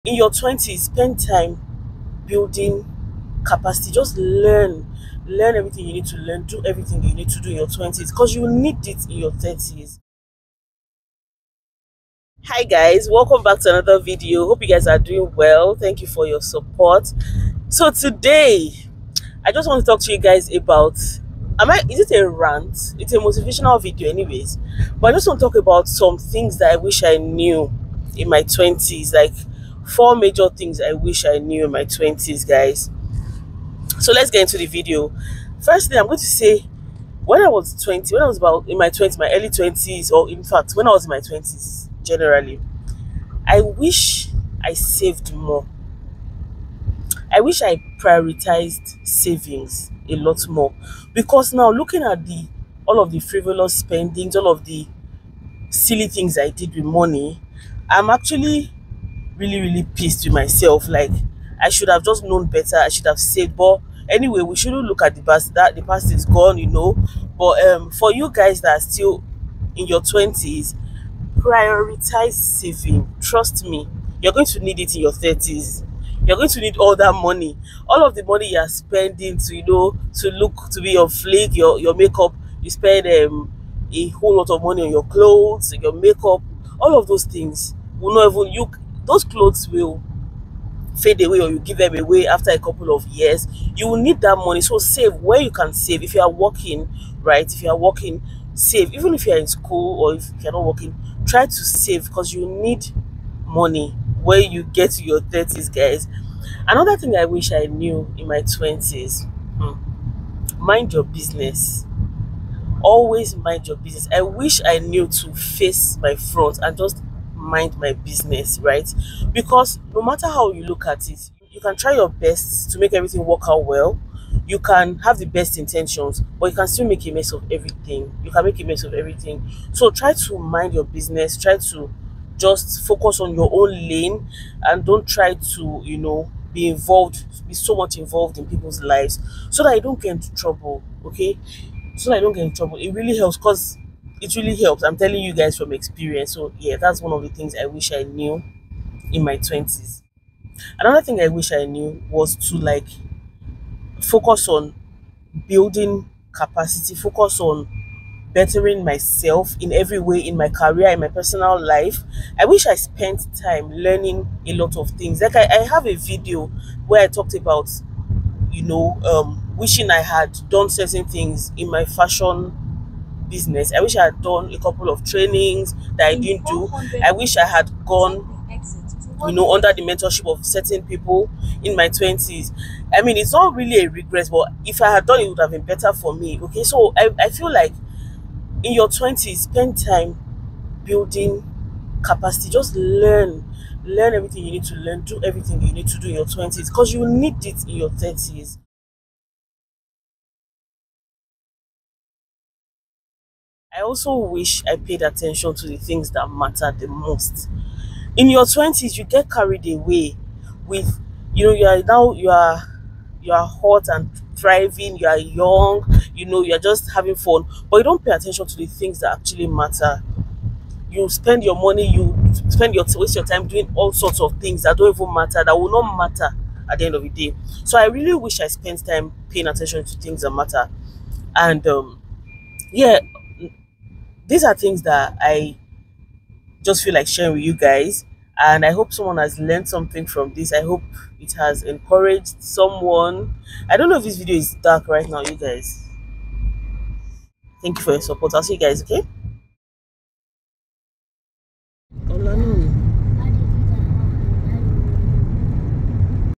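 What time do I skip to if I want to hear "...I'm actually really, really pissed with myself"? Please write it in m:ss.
0:57.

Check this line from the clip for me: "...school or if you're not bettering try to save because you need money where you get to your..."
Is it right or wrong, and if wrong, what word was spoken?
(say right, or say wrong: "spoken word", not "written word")
wrong: "working", not "bettering".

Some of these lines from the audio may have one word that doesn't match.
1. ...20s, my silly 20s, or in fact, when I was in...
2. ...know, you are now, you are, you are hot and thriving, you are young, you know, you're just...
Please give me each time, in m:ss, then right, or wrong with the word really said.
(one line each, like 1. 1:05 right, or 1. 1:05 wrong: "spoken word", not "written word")
1. 0:38 wrong: "early", not "silly"
2. 3:31 right.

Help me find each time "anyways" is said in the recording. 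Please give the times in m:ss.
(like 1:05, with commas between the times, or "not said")
0:24, 1:04.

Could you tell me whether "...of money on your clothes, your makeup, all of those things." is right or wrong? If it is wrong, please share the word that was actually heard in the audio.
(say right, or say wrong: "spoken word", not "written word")
right.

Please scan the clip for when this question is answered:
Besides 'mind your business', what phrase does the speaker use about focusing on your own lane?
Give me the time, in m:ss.
1:55.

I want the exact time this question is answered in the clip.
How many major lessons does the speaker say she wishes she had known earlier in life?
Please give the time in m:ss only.
0:29.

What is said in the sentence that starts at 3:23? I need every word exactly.
I also wish I paid attention to the things that matter the most.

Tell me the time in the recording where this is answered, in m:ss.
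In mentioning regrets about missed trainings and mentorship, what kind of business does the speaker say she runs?
2:51.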